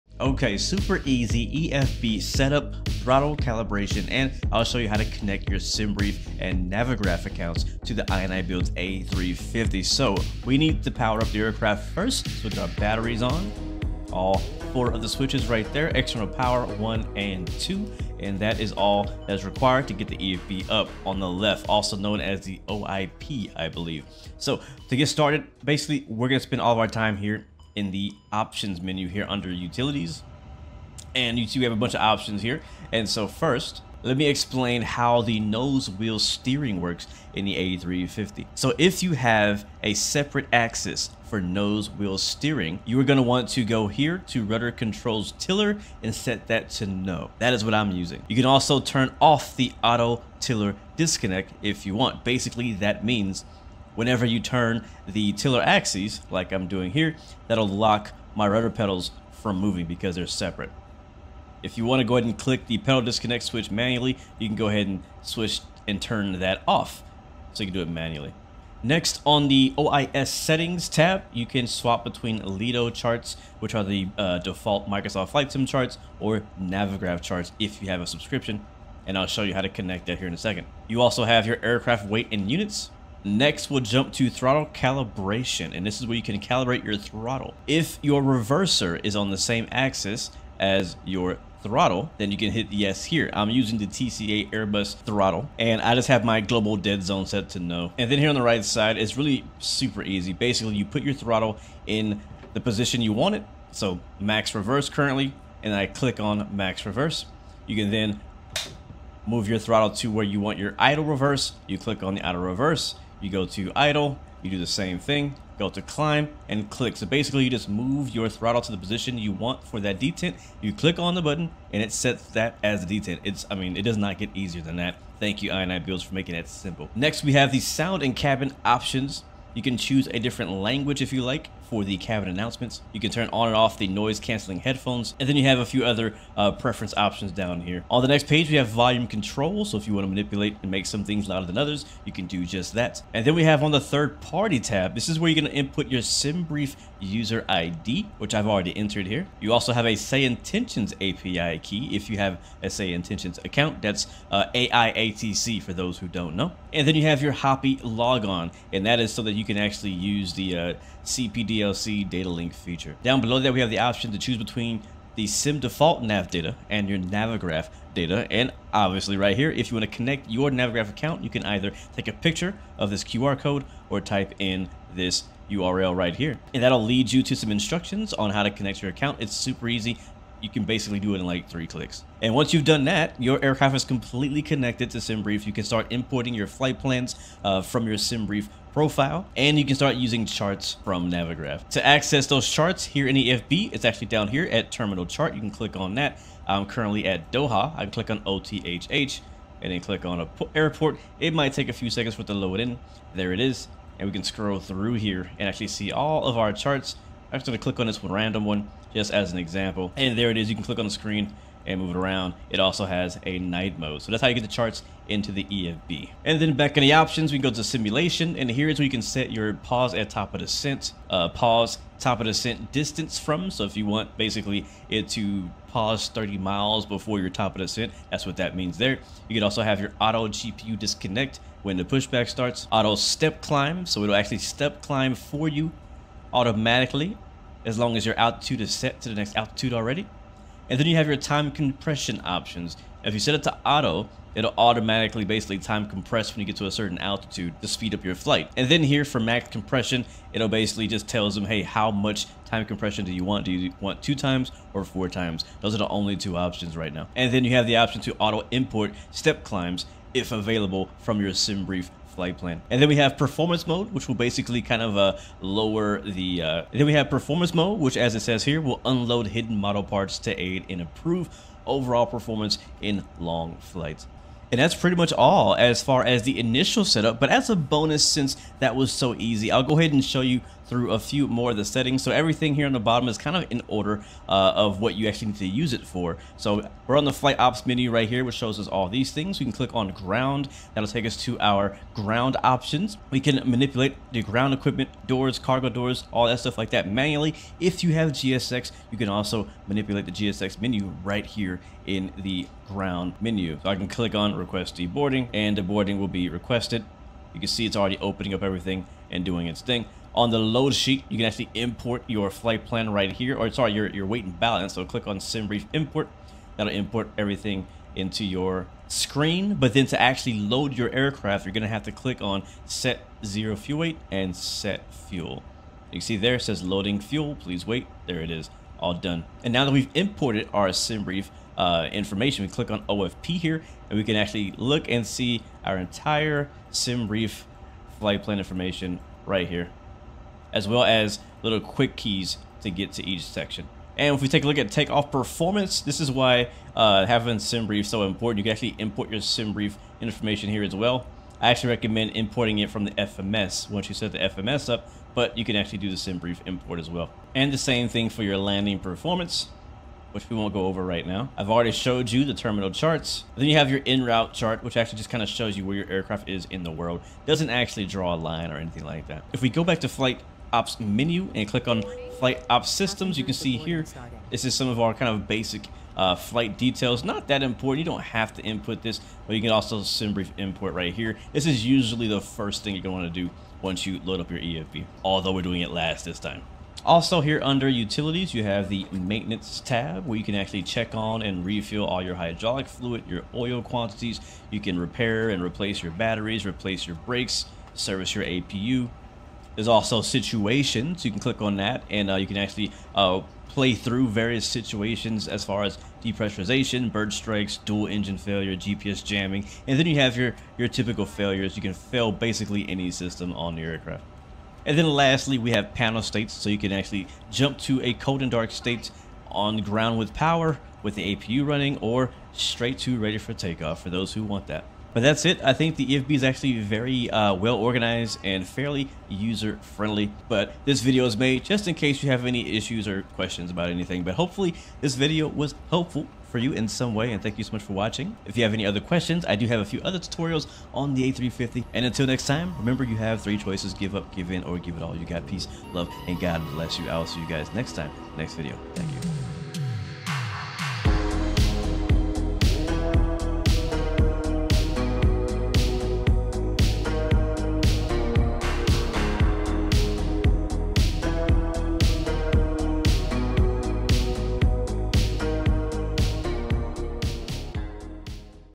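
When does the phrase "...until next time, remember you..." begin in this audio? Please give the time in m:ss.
7:21.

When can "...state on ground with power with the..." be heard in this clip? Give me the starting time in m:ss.
6:58.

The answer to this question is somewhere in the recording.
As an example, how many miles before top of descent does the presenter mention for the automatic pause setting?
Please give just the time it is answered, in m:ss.
3:46.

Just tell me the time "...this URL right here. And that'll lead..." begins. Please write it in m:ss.
2:54.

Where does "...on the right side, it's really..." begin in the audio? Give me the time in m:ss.
1:38.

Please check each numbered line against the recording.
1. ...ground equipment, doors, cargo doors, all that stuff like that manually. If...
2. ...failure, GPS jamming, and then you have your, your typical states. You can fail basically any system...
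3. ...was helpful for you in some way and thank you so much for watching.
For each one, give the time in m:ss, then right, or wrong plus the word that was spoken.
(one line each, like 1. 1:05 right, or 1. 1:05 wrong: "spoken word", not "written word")
1. 4:54 right
2. 6:48 wrong: "failures", not "states"
3. 7:15 right.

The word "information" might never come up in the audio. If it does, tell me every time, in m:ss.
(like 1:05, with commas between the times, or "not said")
5:31, 5:38, 5:49.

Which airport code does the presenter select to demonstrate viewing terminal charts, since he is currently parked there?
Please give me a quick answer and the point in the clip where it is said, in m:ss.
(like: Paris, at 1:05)
OTHH, at 3:18.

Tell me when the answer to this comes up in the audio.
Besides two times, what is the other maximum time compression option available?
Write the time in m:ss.
4:14.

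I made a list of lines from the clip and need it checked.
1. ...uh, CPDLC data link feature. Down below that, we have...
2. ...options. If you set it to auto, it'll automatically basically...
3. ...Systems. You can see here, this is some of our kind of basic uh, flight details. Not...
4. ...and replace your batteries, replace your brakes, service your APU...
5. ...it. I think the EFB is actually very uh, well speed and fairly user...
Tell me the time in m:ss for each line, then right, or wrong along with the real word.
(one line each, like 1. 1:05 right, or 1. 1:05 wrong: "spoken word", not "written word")
1. 2:40 right
2. 4:02 right
3. 6:12 right
4. 6:35 right
5. 7:05 wrong: "organized", not "speed".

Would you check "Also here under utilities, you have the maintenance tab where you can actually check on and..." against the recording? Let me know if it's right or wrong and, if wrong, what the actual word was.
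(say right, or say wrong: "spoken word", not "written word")
right.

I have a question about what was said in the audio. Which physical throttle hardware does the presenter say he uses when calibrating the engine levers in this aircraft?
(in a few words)
TCA Airbus throttle.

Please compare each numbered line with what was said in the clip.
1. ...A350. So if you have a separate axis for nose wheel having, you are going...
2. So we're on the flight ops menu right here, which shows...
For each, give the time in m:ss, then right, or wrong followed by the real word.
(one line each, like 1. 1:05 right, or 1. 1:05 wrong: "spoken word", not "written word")
1. 0:37 wrong: "steering", not "having"
2. 4:46 right.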